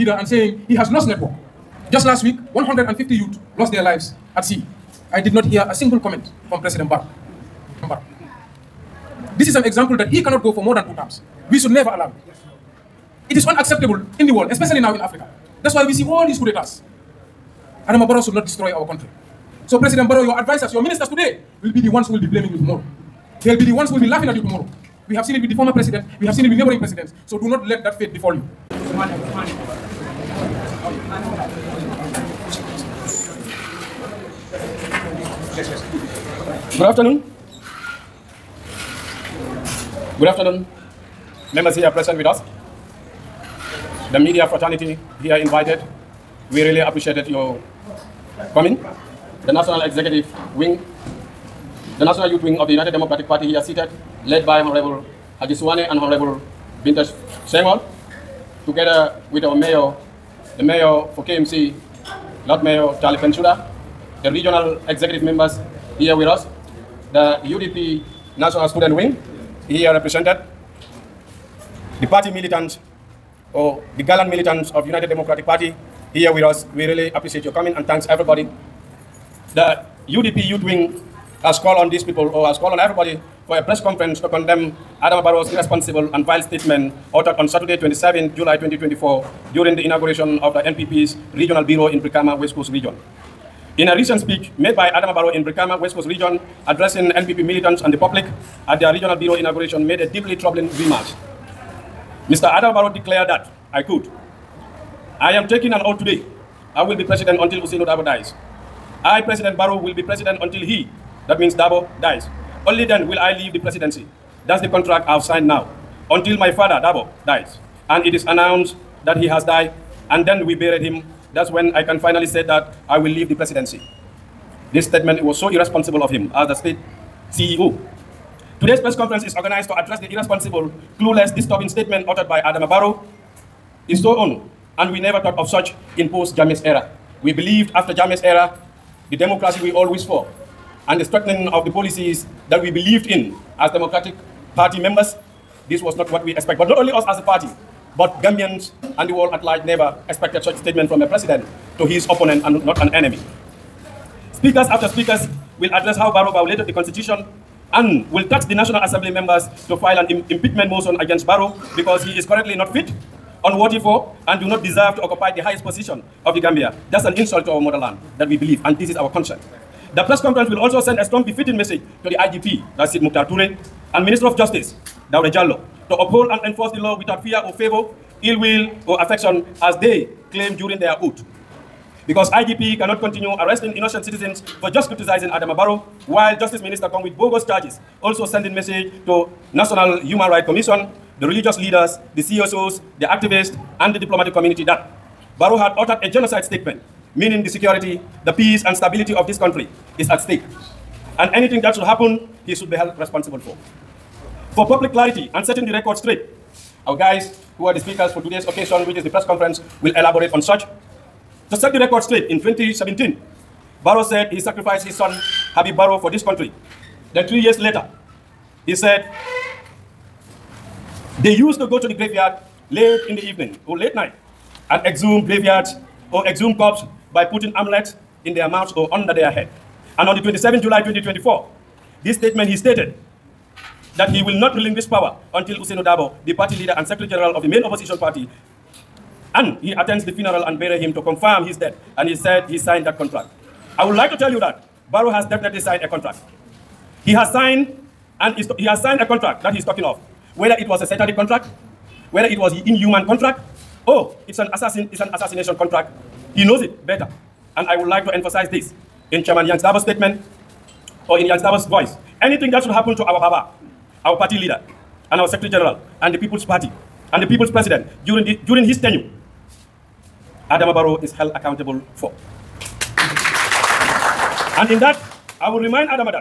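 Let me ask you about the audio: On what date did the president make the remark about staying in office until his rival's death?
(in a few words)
27 July 2024.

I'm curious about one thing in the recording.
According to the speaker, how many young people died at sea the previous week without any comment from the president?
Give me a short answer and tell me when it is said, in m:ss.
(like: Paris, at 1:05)
150, at 0:02.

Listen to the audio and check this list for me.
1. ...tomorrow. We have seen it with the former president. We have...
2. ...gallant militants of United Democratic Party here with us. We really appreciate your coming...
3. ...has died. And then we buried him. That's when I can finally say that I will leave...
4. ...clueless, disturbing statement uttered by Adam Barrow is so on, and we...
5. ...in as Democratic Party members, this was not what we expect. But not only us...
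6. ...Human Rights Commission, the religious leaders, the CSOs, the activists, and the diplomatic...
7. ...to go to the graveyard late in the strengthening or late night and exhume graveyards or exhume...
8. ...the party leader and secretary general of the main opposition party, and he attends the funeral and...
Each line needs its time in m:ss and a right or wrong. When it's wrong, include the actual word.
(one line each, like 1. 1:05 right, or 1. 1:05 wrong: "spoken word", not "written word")
1. 0:24 right
2. 1:14 right
3. 1:59 right
4. 2:10 right
5. 2:23 right
6. 3:10 right
7. 3:41 wrong: "evening", not "strengthening"
8. 3:56 right.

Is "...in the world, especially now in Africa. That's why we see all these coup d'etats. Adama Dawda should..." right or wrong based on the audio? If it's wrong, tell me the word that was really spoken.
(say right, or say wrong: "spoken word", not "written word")
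wrong: "Barrow", not "Dawda".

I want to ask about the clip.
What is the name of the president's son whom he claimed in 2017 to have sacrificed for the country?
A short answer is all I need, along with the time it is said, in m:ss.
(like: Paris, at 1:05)
Habib Barrow, at 3:35.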